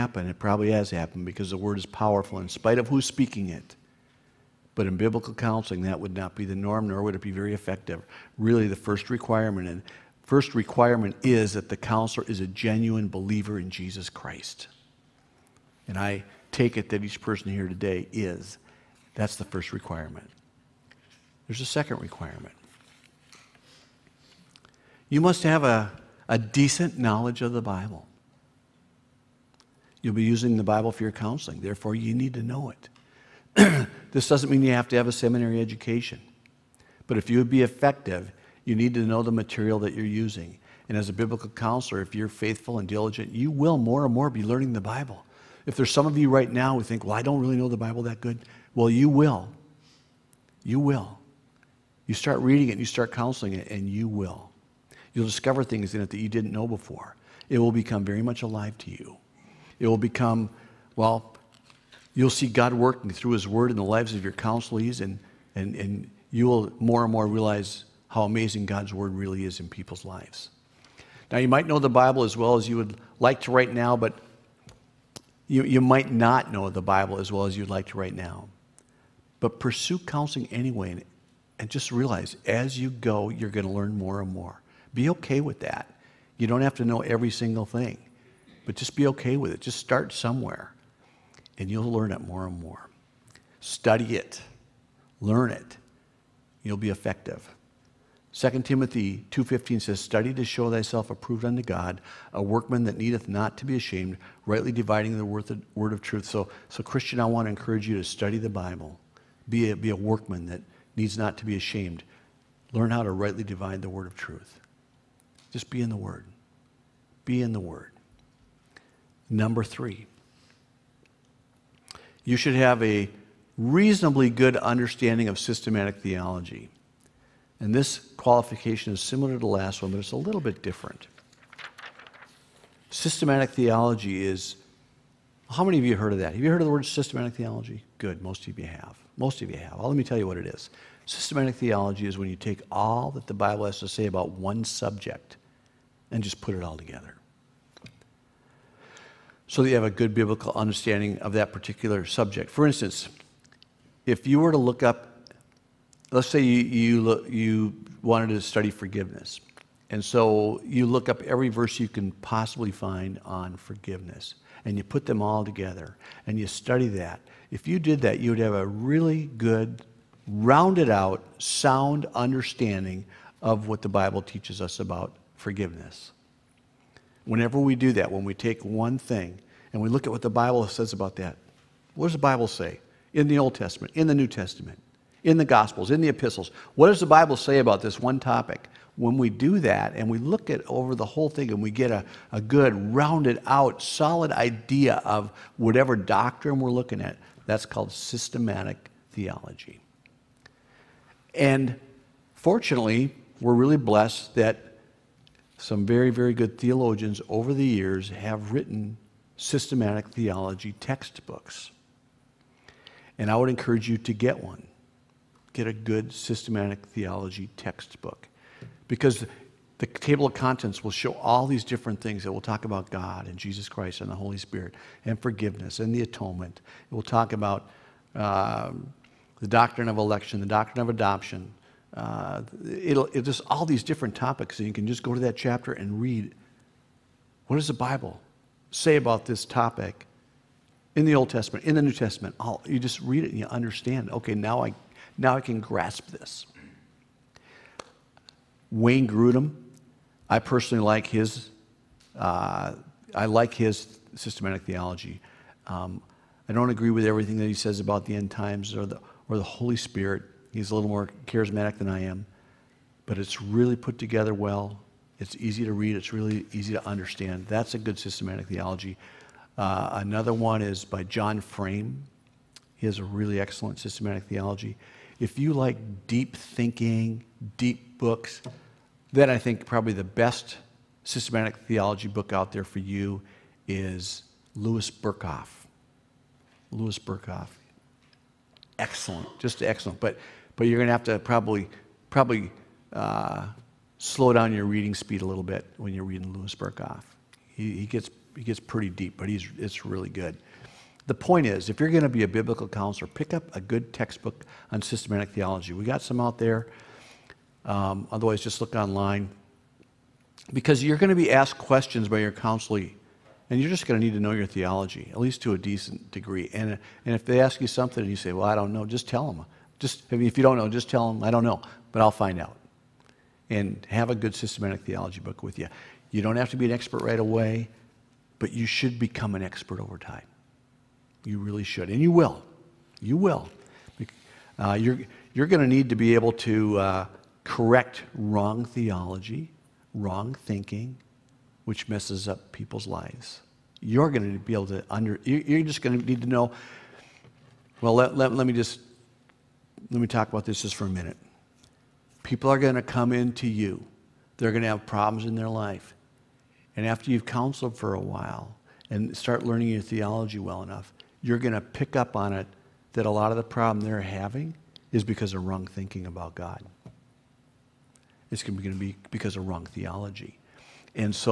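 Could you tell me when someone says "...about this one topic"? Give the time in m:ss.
3:07.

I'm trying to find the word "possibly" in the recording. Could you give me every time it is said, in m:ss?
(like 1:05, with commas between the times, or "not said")
2:42.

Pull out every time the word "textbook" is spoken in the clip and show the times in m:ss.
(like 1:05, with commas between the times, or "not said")
3:30, 3:37, 5:03.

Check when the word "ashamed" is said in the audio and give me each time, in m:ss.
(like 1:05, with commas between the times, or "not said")
1:43, 1:51.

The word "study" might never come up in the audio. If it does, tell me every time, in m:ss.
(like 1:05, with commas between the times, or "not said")
1:33, 1:39, 1:48, 2:38, 2:46.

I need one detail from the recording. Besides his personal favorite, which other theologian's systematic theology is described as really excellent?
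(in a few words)
John Frame.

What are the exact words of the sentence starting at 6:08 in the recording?
It's going to be because of wrong theology.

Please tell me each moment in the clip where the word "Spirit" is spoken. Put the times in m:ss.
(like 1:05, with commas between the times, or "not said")
3:44, 4:19.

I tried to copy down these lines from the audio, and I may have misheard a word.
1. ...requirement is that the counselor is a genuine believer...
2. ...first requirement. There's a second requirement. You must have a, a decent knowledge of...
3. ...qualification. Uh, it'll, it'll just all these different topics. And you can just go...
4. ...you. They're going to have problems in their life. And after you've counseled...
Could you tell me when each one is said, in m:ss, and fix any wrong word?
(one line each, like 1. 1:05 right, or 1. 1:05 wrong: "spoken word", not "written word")
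1. 0:10 right
2. 0:19 right
3. 3:50 wrong: "adoption", not "qualification"
4. 5:53 right.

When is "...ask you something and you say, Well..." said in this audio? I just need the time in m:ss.
5:17.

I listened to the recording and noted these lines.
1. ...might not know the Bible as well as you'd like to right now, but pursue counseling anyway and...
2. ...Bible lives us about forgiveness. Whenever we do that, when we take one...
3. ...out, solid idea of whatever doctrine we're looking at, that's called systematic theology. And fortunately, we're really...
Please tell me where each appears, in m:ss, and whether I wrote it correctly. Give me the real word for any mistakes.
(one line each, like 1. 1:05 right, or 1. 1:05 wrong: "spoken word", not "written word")
1. 1:15 right
2. 2:53 wrong: "teaches", not "lives"
3. 3:13 right.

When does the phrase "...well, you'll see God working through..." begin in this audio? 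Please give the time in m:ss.
1:00.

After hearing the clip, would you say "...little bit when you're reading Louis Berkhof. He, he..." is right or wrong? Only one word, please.
right.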